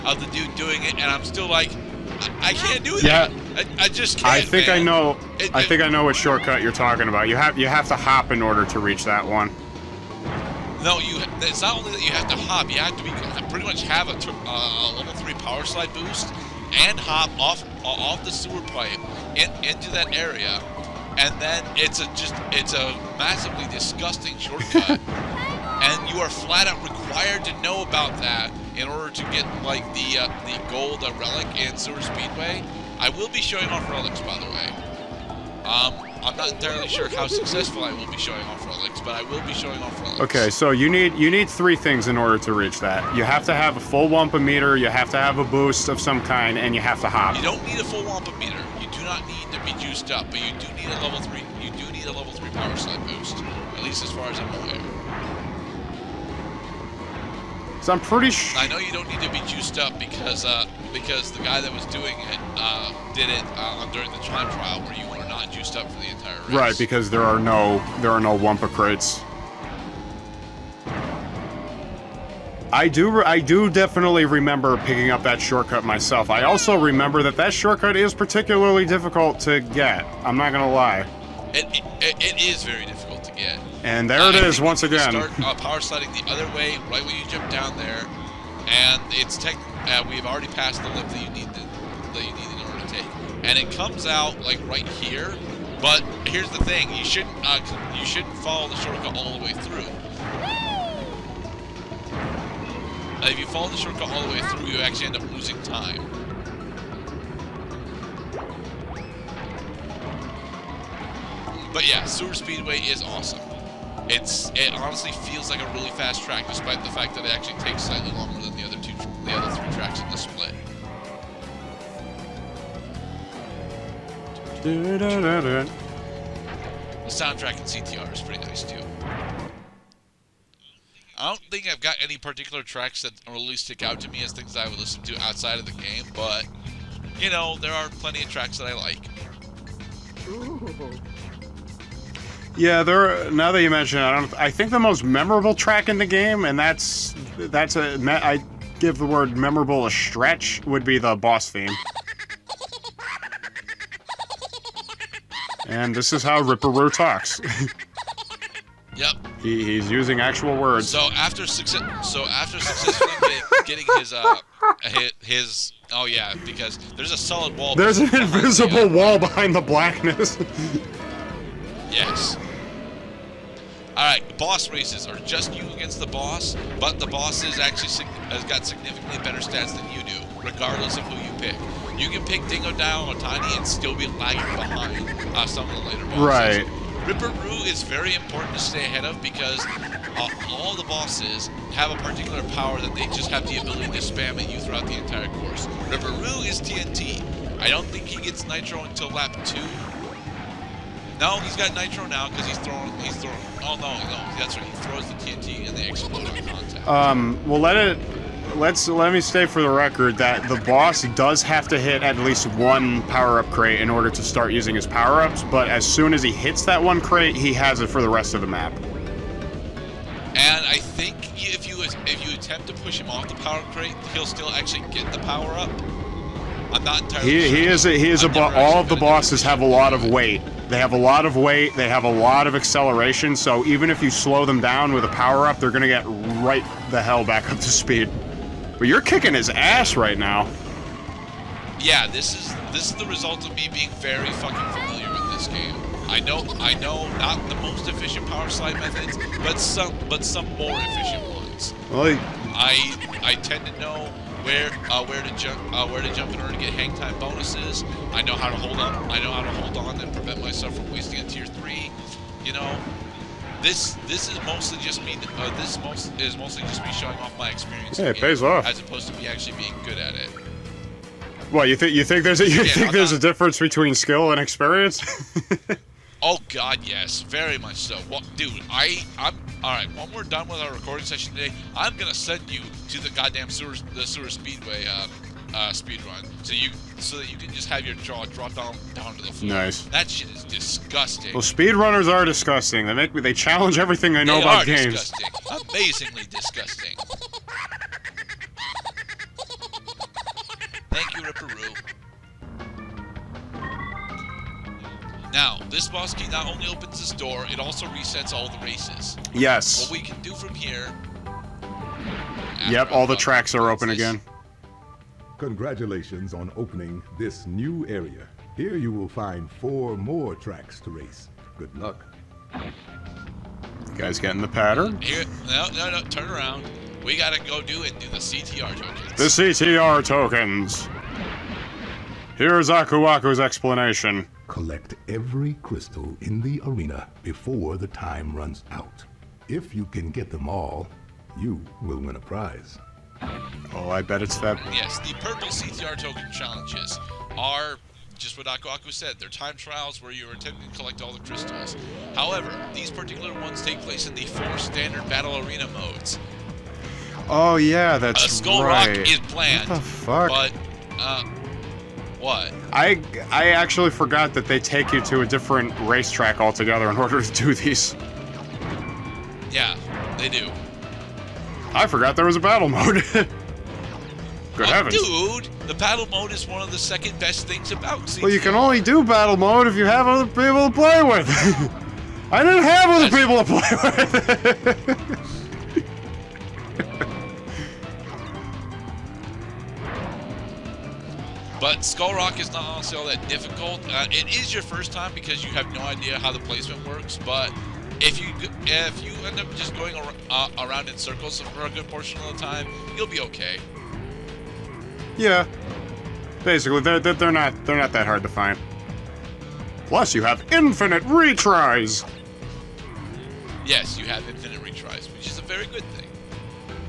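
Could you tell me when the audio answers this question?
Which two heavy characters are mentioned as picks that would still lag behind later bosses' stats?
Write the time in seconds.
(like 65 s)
182 s.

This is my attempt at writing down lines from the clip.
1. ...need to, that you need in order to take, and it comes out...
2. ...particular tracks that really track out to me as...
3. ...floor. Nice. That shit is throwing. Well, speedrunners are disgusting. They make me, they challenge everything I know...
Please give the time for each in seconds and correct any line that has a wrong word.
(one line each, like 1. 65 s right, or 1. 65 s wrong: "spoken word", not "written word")
1. 91 s right
2. 132 s wrong: "stick", not "track"
3. 289 s wrong: "disgusting", not "throwing".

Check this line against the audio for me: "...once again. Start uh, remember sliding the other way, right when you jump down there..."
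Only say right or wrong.
wrong.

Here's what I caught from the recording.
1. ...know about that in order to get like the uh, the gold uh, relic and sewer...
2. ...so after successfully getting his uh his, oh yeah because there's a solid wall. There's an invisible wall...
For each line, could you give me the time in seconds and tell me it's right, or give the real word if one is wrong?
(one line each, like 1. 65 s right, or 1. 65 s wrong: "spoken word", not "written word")
1. 27 s right
2. 162 s right.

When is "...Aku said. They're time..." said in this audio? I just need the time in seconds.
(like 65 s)
348 s.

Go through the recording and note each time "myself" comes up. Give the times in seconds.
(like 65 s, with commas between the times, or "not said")
75 s, 260 s.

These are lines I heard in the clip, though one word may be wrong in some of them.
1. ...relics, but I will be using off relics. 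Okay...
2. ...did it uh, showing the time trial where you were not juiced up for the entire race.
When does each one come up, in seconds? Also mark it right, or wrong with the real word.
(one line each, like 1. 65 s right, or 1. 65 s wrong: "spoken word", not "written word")
1. 38 s wrong: "showing", not "using"
2. 63 s wrong: "during", not "showing".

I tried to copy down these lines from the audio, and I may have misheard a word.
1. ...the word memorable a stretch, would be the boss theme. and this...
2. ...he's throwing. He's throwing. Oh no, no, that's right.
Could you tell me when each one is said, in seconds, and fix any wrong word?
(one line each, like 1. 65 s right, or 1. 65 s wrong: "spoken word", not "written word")
1. 148 s right
2. 202 s right.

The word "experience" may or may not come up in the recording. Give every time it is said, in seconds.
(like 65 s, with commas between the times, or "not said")
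267 s, 274 s.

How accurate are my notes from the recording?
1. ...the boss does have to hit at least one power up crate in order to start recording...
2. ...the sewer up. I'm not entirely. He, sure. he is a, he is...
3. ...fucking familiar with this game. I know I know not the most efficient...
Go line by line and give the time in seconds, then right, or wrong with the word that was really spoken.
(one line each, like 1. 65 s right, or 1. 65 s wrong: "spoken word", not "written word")
1. 210 s wrong: "using", not "recording"
2. 225 s wrong: "power", not "sewer"
3. 244 s right.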